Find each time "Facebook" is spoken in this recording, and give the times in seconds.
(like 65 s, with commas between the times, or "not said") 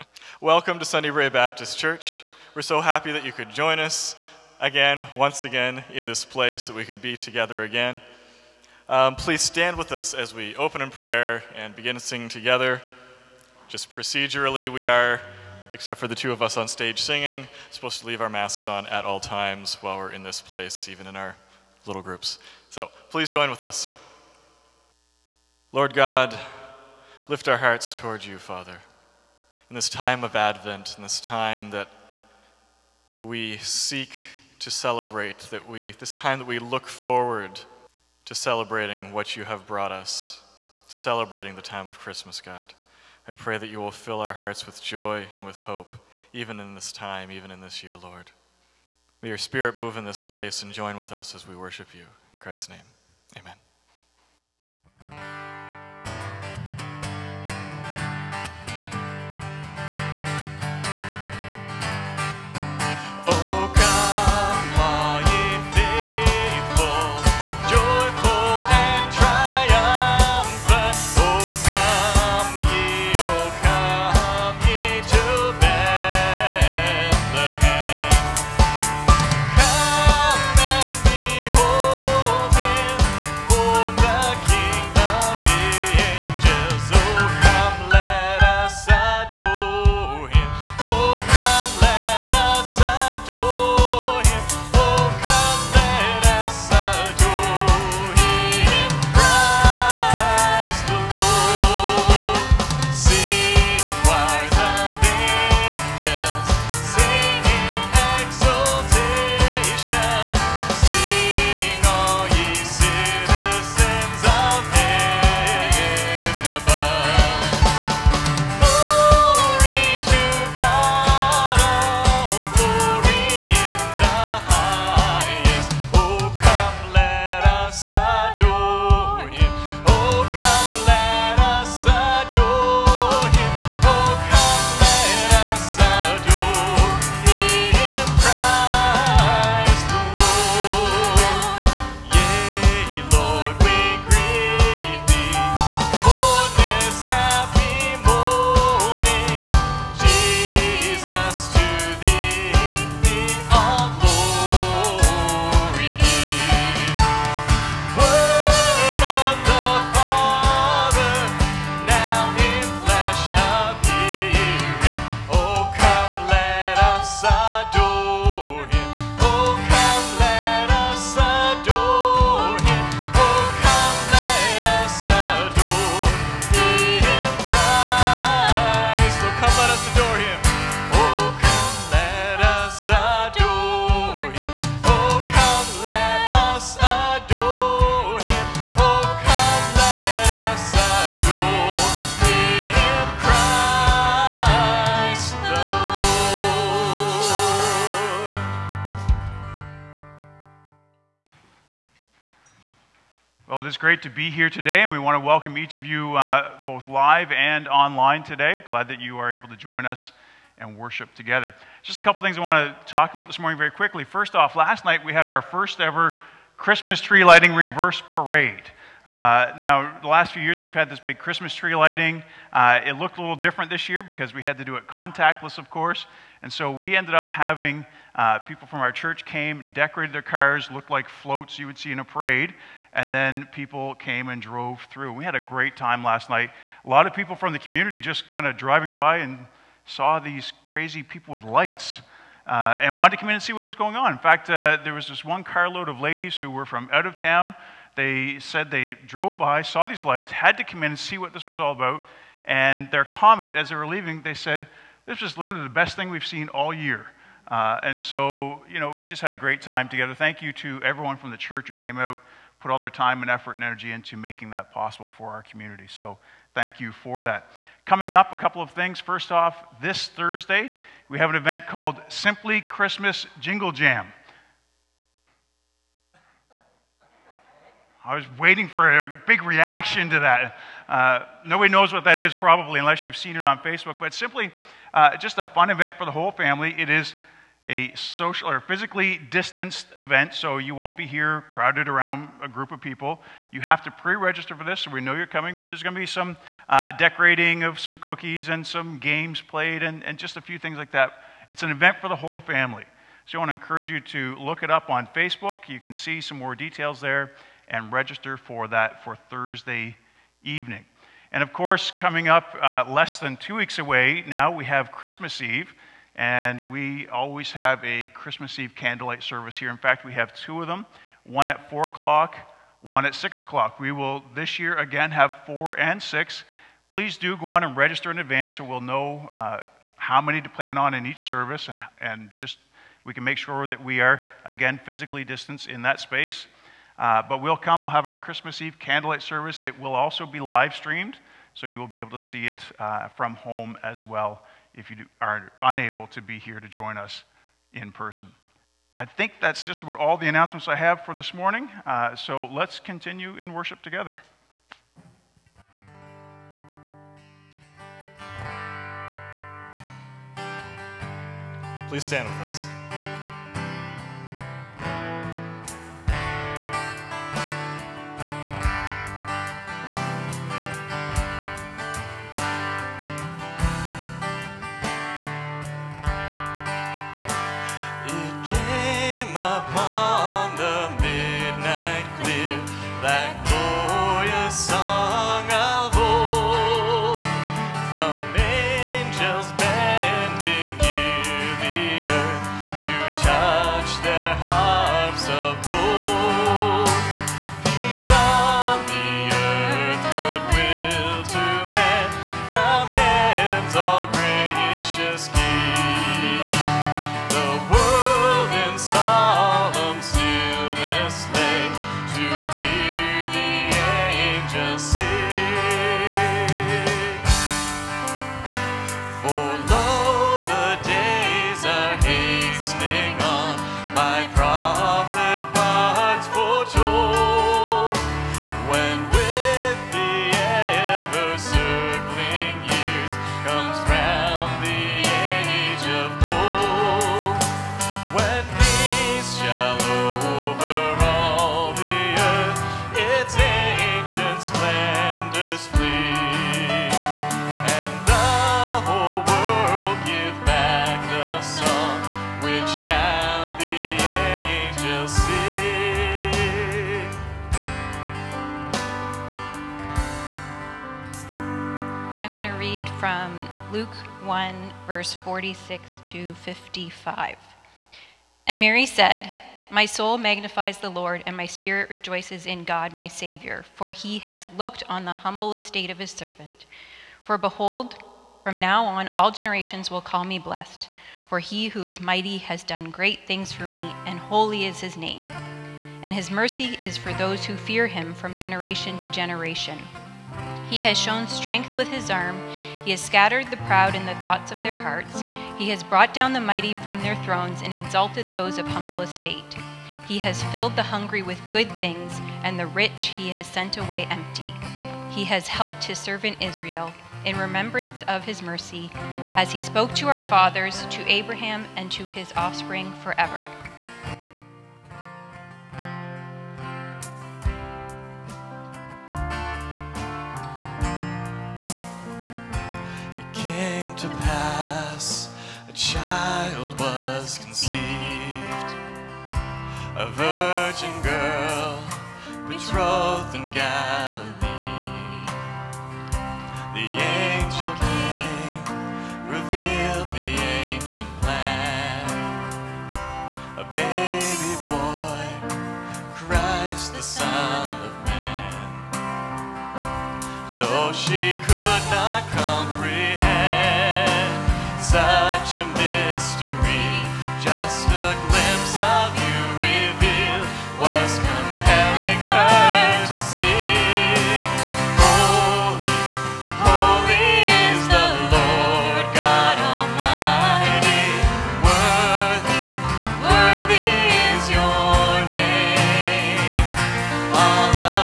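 283 s, 305 s.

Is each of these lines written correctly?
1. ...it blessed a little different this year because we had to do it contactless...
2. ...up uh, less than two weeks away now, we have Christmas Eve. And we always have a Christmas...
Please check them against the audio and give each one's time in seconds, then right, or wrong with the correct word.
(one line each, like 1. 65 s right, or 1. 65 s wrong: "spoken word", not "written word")
1. 222 s wrong: "looked", not "blessed"
2. 312 s right.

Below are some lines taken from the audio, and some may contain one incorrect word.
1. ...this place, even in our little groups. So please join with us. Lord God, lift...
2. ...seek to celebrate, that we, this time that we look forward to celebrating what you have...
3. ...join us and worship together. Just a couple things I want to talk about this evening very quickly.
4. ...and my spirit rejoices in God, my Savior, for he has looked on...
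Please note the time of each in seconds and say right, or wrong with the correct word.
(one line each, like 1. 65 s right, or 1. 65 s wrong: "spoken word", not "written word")
1. 20 s right
2. 33 s right
3. 209 s wrong: "morning", not "evening"
4. 471 s right.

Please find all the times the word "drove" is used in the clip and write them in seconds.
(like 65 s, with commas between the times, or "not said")
234 s, 249 s.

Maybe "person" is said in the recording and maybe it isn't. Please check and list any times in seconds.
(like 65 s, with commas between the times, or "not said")
347 s.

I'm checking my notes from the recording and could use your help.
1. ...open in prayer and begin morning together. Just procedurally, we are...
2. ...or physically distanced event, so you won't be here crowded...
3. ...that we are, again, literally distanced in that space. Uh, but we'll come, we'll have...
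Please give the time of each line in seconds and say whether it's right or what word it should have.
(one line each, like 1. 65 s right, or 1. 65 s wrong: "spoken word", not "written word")
1. 10 s wrong: "singing", not "morning"
2. 288 s right
3. 333 s wrong: "physically", not "literally".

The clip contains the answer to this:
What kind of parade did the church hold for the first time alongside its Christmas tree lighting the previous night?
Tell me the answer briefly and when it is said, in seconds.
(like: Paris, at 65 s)
Reverse parade, at 217 s.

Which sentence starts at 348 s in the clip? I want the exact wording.
I think that's just about all the announcements I have for this morning.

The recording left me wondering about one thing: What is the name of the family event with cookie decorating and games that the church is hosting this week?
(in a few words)
Simply Christmas Jingle Jam.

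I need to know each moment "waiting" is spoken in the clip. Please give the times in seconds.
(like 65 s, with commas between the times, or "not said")
278 s.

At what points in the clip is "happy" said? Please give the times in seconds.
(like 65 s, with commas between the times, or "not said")
2 s.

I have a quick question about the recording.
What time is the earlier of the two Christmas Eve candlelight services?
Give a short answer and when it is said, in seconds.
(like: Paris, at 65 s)
4 o'clock, at 321 s.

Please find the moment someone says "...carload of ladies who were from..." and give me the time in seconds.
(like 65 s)
245 s.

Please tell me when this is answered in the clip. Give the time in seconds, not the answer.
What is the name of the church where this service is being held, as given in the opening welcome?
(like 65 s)
0 s.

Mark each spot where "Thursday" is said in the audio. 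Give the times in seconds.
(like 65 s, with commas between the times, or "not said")
270 s, 309 s.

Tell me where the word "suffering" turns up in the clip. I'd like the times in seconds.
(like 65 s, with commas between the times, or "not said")
not said.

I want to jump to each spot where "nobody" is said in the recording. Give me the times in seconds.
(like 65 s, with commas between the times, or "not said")
281 s.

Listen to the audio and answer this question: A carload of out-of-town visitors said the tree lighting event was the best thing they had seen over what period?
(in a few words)
All year.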